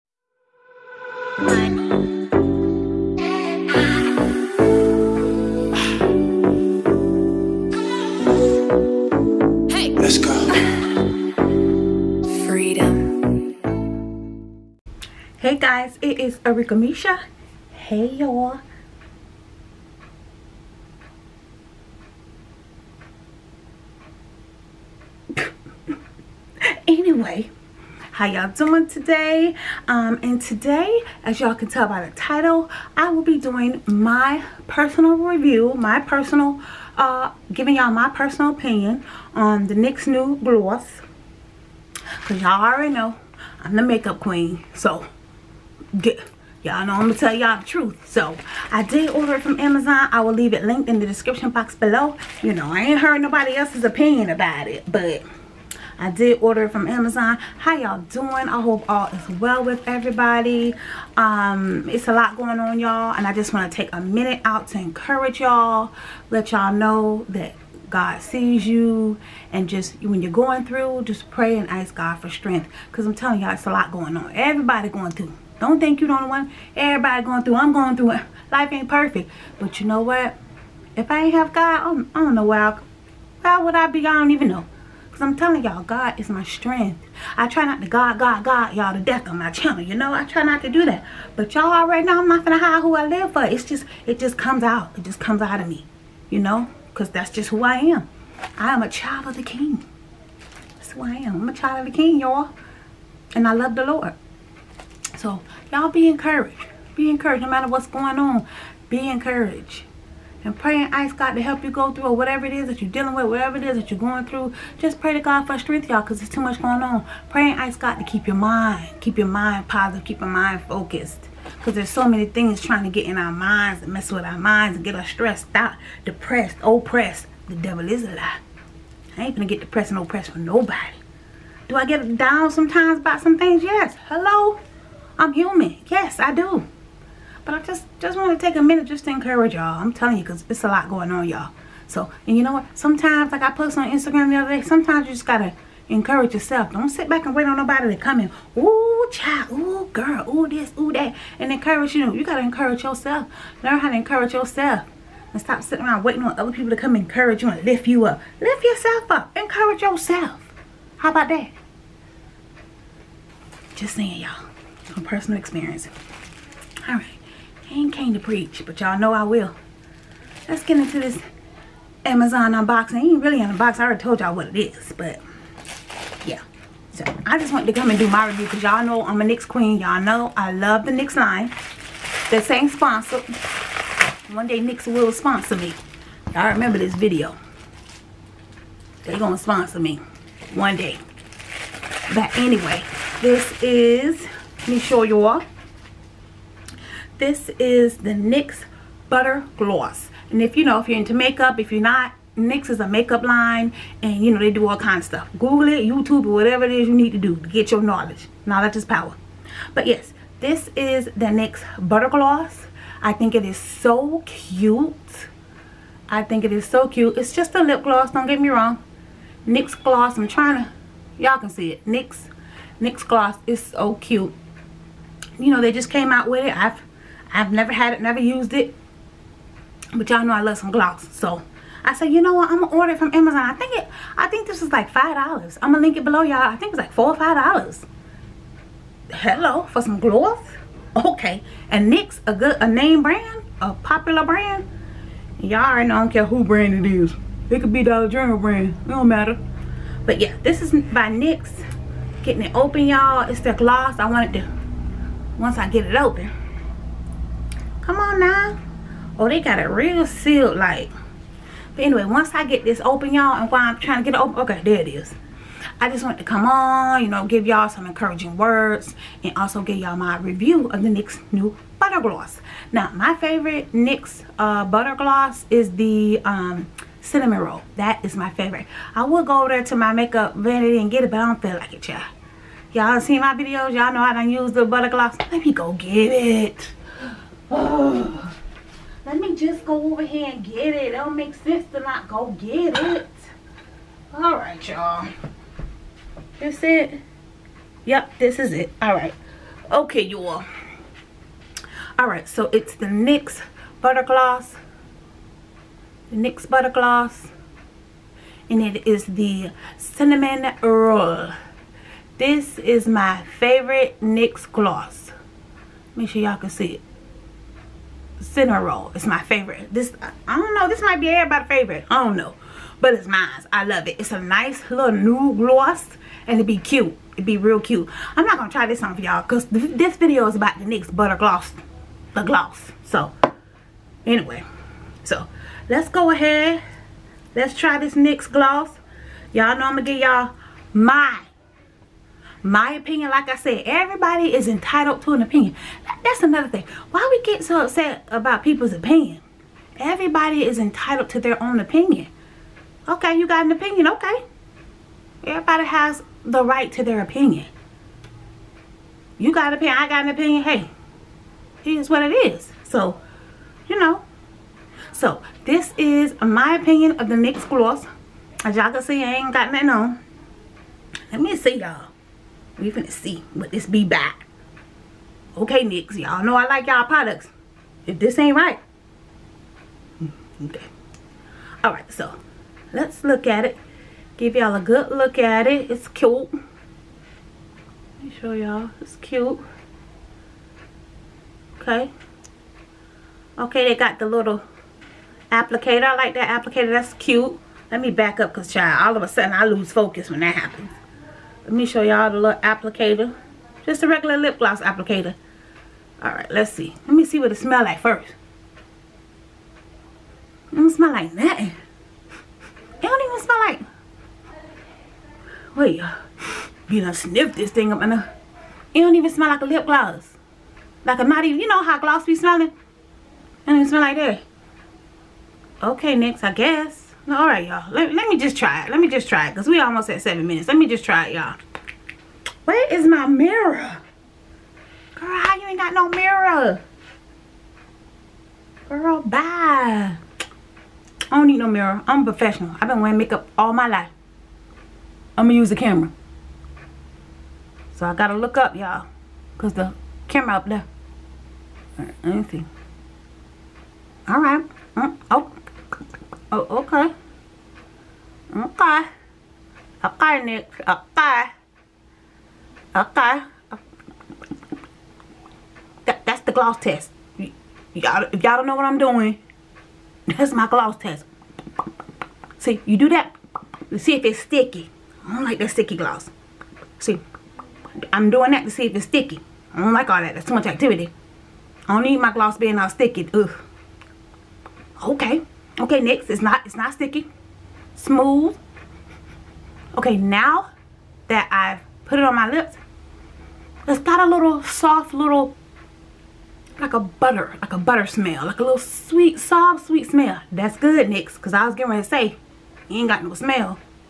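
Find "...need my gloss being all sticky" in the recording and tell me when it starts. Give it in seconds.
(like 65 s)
481 s.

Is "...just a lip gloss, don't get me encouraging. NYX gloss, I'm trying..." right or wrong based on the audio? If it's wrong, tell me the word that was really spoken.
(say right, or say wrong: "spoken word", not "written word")
wrong: "wrong", not "encouraging".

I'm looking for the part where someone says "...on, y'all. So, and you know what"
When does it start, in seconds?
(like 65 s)
141 s.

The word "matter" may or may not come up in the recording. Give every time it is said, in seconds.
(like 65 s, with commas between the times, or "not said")
107 s, 249 s.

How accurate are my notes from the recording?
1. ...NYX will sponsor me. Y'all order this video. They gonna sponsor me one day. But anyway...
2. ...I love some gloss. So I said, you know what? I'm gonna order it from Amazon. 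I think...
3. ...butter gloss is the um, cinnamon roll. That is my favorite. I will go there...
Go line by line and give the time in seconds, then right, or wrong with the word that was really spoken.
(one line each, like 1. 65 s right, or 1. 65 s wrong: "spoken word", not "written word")
1. 184 s wrong: "remember", not "order"
2. 230 s right
3. 274 s right.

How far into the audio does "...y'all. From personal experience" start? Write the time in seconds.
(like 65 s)
164 s.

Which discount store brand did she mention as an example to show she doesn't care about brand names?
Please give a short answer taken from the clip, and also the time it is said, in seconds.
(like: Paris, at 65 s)
Dollar General, at 247 s.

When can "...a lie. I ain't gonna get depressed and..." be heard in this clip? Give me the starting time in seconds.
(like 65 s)
128 s.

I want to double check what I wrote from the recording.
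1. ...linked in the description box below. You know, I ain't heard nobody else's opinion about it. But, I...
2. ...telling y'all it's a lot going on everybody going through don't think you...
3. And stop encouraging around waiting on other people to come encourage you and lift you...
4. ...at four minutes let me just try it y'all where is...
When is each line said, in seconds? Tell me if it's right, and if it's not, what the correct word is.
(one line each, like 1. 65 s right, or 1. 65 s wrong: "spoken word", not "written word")
1. 50 s right
2. 73 s right
3. 155 s wrong: "sitting", not "encouraging"
4. 429 s wrong: "seven", not "four".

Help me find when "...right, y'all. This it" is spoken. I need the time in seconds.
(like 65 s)
294 s.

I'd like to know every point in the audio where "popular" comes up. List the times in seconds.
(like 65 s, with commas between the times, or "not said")
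243 s.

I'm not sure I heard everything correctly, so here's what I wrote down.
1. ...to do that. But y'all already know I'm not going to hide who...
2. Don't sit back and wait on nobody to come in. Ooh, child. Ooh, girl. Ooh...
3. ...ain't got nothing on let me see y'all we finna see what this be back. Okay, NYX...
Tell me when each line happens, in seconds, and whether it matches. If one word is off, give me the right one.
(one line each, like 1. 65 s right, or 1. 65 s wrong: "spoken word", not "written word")
1. 90 s right
2. 146 s right
3. 369 s right.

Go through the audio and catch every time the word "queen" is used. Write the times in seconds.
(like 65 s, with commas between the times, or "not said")
44 s, 179 s.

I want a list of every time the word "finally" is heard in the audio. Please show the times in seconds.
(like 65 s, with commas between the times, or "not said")
not said.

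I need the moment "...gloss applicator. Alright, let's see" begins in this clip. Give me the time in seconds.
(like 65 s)
404 s.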